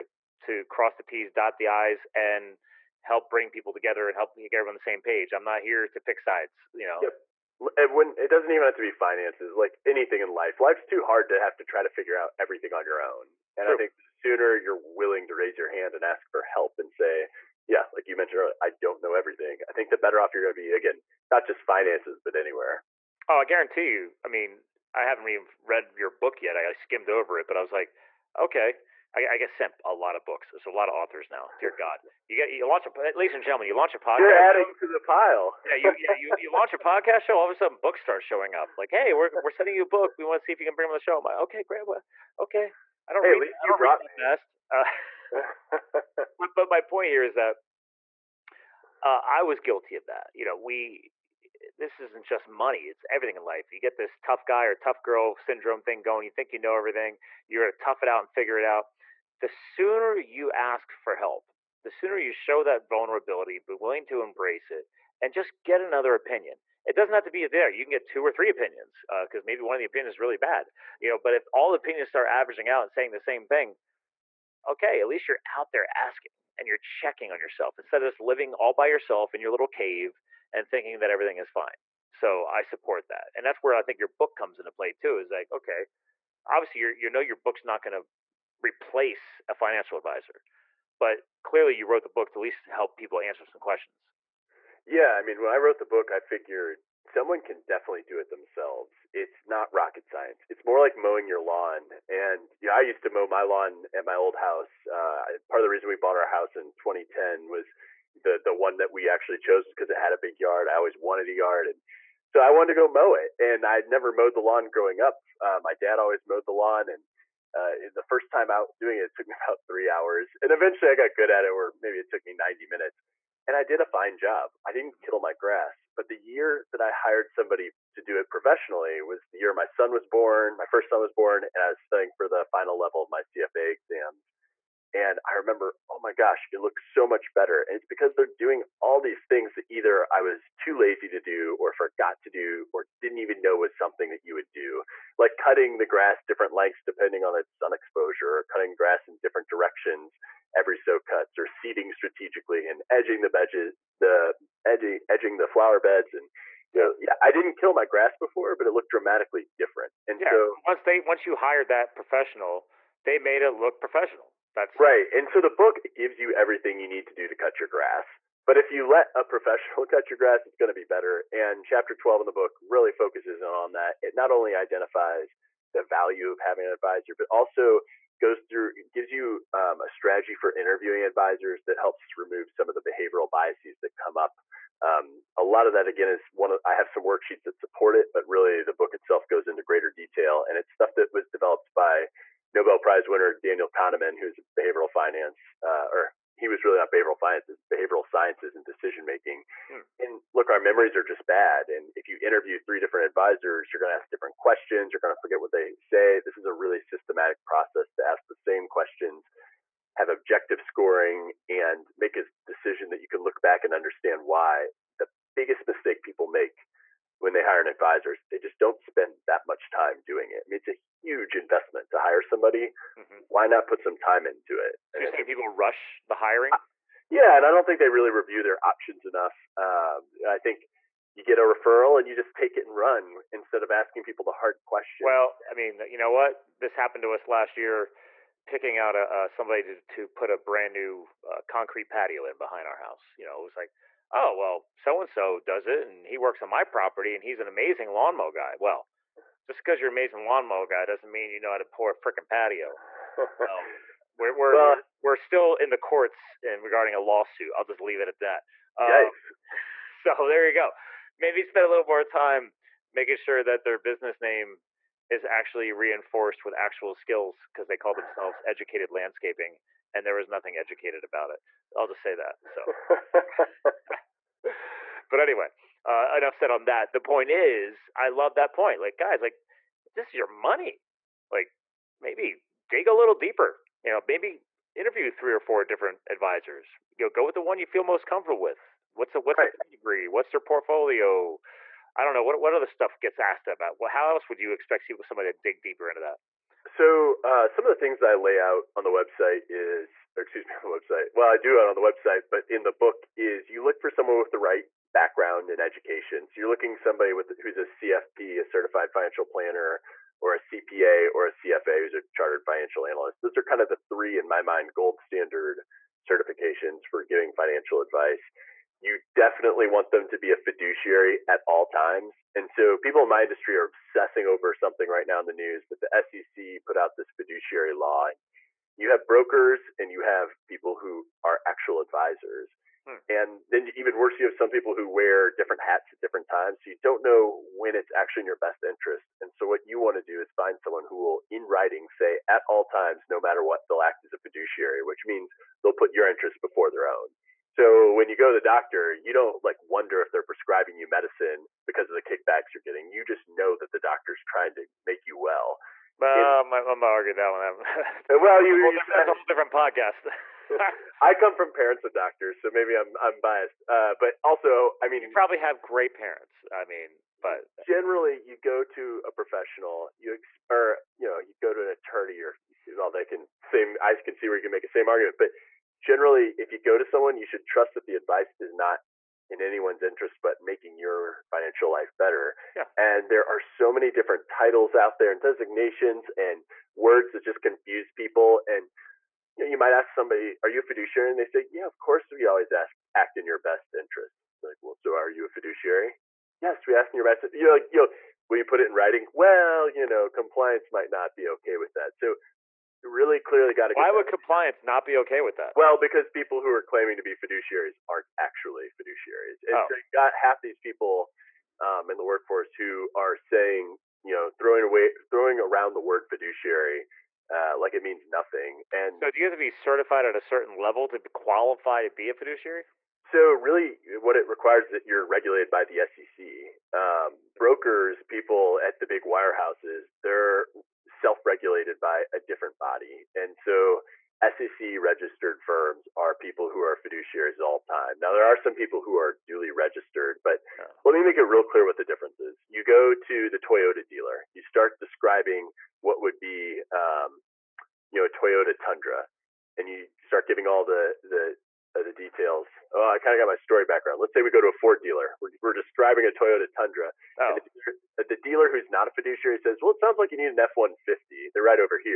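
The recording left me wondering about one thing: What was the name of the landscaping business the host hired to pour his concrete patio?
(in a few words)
Educated Landscaping.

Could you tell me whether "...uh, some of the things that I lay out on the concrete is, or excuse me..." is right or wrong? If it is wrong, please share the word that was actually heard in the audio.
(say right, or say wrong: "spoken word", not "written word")
wrong: "website", not "concrete".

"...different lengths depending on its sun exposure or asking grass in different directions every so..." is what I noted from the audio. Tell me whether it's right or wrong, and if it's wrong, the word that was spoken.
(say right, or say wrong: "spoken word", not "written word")
wrong: "cutting", not "asking".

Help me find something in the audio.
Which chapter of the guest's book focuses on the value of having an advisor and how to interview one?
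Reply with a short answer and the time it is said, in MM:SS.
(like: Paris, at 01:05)
Chapter 12, at 02:51.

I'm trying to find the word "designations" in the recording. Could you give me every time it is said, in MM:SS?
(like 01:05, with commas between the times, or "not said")
06:25.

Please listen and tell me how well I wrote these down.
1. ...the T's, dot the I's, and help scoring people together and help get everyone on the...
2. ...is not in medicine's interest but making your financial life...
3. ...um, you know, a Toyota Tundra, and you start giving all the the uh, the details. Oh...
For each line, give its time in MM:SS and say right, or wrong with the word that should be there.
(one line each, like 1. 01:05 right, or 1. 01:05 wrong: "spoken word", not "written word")
1. 00:00 wrong: "bring", not "scoring"
2. 06:18 wrong: "anyone", not "medicine"
3. 07:26 right.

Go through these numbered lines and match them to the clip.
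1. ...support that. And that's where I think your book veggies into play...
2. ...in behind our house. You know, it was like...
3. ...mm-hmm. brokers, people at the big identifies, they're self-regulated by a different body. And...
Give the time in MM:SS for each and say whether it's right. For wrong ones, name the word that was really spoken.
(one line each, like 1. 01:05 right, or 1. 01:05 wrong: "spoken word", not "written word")
1. 01:22 wrong: "comes", not "veggies"
2. 04:02 right
3. 07:06 wrong: "wirehouses", not "identifies".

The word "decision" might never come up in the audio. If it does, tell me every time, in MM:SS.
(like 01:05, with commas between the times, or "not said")
03:18, 03:32.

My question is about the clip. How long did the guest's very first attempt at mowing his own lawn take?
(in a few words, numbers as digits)
about three hours.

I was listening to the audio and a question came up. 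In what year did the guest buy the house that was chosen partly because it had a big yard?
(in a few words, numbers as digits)
2010.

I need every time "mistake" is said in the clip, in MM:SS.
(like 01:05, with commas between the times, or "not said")
03:35.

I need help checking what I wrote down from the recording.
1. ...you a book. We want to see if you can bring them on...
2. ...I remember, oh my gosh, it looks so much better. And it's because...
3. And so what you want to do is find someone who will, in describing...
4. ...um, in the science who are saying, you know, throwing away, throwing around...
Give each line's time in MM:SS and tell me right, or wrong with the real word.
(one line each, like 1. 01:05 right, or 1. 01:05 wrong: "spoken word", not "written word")
1. 00:39 right
2. 02:15 right
3. 05:39 wrong: "writing", not "describing"
4. 06:51 wrong: "workforce", not "science".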